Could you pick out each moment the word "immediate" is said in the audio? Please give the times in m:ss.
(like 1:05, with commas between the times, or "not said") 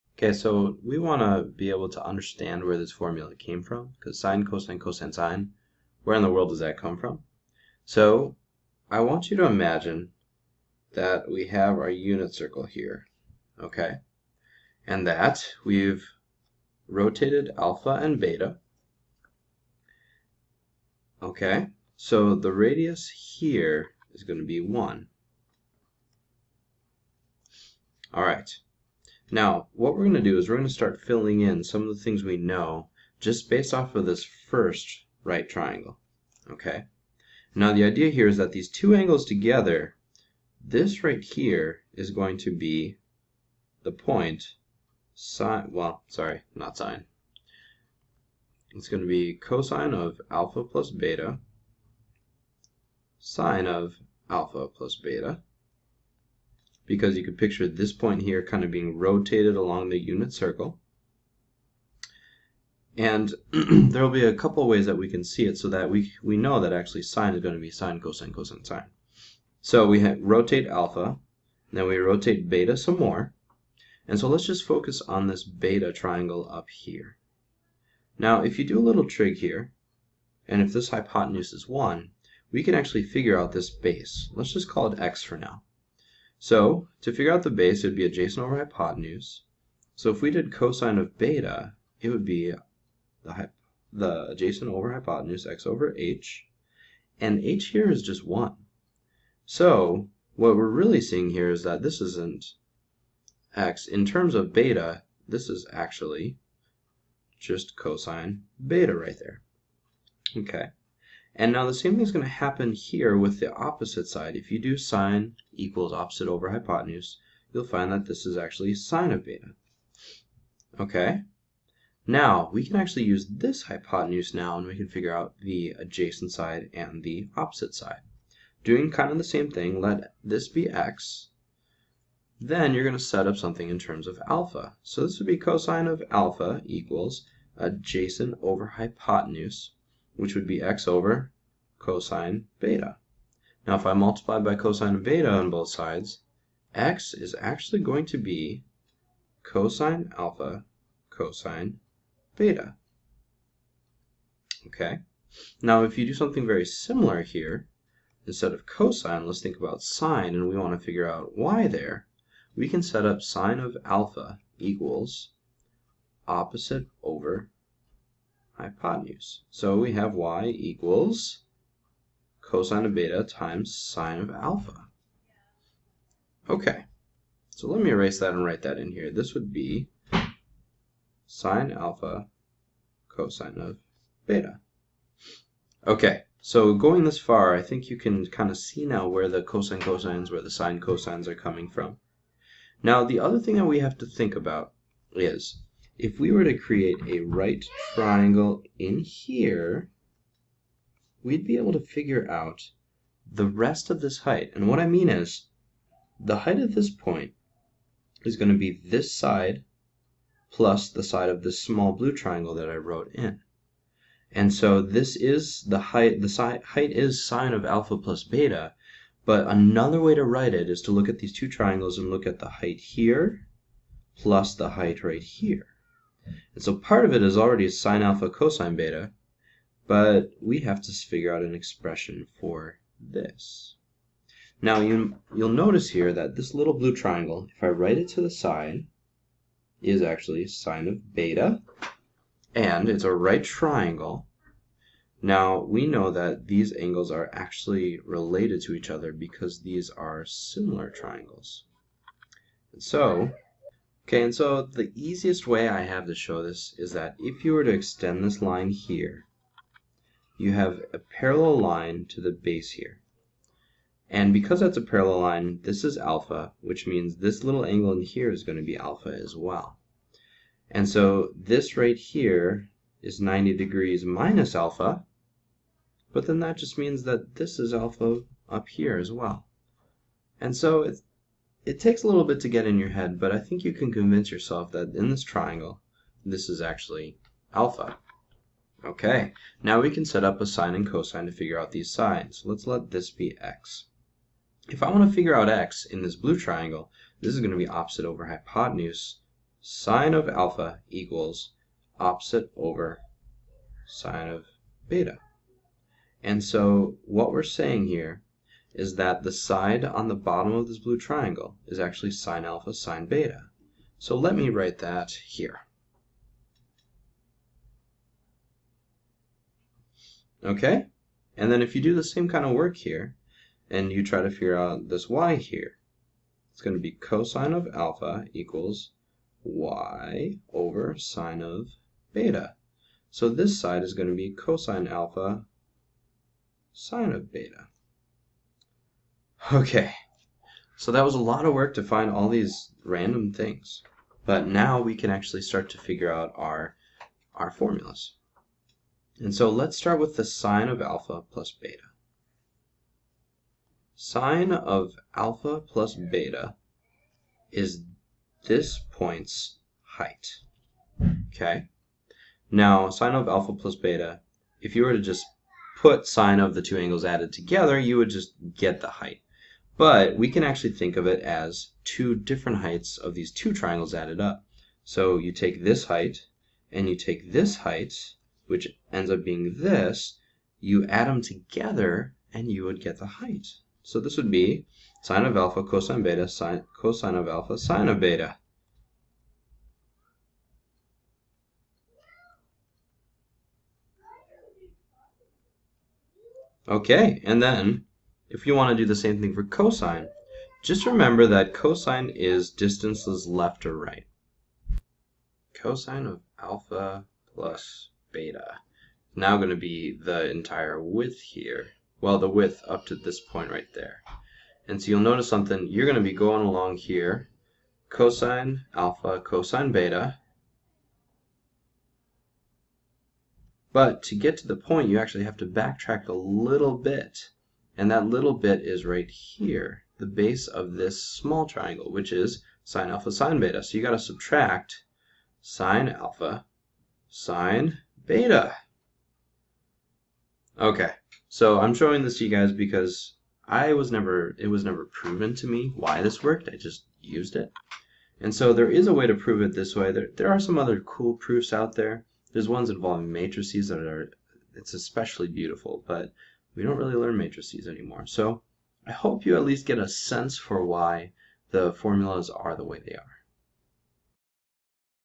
not said.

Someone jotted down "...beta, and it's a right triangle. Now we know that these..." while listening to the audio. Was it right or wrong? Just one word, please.
right.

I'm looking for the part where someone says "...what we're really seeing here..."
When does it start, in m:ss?
1:40.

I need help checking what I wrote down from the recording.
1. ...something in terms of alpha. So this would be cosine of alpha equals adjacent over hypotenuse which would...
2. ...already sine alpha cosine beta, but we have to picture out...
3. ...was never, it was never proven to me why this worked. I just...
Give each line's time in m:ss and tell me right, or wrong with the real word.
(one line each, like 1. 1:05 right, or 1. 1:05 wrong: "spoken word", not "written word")
1. 2:13 right
2. 3:47 wrong: "figure", not "picture"
3. 7:23 right.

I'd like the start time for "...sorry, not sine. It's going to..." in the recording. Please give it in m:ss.
0:46.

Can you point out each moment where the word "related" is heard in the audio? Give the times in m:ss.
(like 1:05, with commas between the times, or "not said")
4:08.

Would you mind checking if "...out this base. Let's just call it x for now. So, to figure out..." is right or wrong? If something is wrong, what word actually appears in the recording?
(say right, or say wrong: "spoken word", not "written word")
right.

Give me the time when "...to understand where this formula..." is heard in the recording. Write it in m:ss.
0:01.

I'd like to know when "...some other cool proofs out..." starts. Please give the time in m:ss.
7:30.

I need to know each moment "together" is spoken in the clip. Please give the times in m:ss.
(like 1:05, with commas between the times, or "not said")
0:39, 6:07, 6:21.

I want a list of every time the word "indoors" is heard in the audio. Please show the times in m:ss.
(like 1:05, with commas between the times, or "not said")
not said.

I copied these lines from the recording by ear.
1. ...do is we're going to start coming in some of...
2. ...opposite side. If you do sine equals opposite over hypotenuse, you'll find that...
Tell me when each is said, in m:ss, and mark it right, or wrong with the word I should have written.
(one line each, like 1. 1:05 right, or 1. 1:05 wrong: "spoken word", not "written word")
1. 0:30 wrong: "filling", not "coming"
2. 1:53 right.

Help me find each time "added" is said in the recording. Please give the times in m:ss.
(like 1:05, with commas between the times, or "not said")
6:07, 6:13.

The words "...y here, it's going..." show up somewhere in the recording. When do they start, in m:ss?
5:25.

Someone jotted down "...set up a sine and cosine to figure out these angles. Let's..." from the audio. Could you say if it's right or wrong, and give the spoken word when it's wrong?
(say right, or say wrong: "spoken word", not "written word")
wrong: "sides", not "angles".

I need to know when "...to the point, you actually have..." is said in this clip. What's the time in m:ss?
7:04.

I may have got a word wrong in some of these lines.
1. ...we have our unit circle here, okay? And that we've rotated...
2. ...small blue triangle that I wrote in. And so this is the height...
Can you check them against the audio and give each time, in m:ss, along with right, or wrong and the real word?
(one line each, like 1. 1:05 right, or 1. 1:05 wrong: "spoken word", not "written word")
1. 0:11 right
2. 3:31 right.